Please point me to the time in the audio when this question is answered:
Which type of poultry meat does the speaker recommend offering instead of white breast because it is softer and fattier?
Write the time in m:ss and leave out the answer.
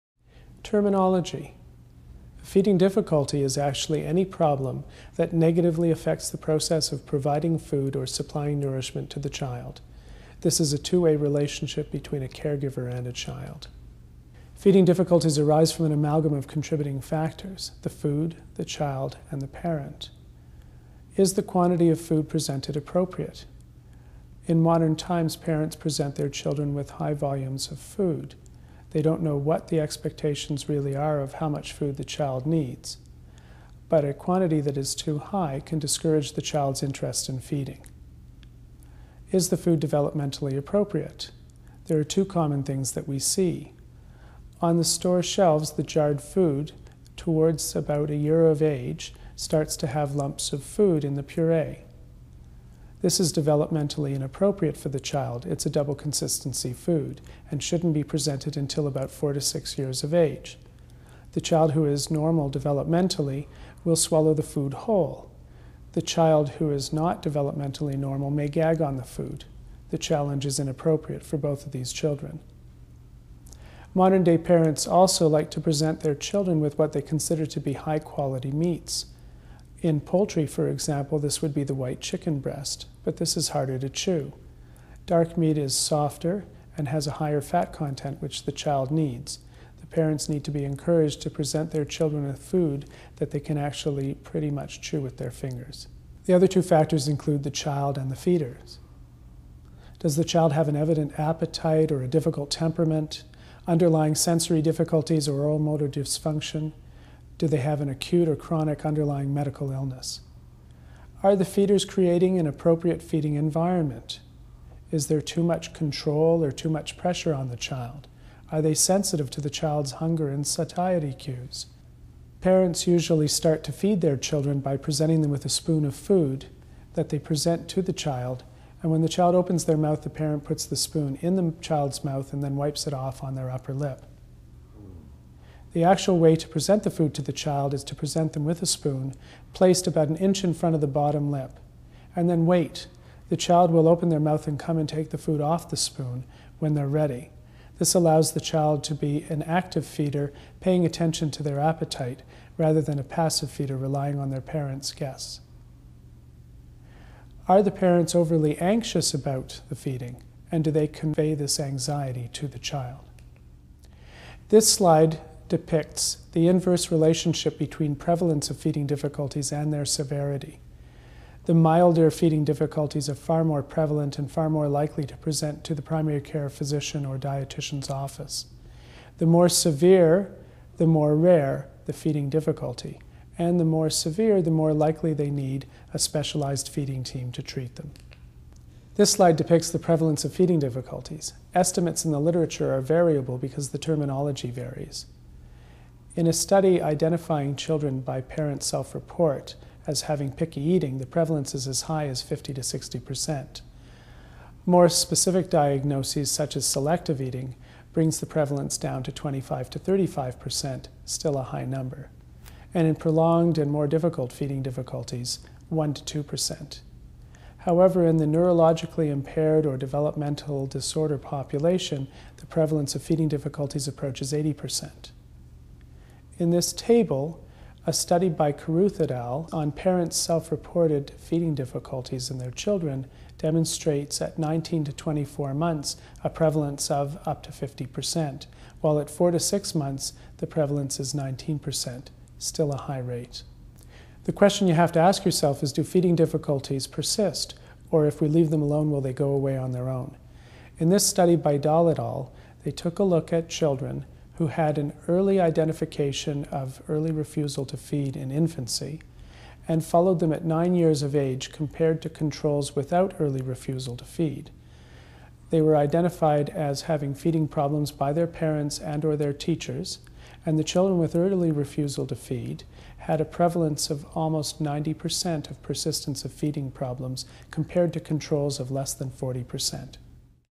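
1:25.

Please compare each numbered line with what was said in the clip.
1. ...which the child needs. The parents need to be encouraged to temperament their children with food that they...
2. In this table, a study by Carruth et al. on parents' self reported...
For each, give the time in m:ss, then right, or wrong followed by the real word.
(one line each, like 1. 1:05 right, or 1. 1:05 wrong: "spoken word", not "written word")
1. 1:28 wrong: "present", not "temperament"
2. 3:46 right.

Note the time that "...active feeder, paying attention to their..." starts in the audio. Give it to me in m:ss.
2:29.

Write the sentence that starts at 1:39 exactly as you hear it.
Does the child have an evident appetite or a difficult temperament, underlying sensory difficulties or oral motor dysfunction?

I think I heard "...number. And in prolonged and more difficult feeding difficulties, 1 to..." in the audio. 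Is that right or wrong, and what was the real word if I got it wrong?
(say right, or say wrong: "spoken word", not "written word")
right.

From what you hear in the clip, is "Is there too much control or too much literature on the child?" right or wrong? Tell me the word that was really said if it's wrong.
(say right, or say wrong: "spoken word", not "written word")
wrong: "pressure", not "literature".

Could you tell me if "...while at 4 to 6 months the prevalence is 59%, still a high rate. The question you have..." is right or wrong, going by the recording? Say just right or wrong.
wrong.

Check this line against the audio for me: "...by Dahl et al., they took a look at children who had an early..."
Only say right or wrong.
right.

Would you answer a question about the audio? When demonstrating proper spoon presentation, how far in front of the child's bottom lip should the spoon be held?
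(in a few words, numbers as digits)
About an inch.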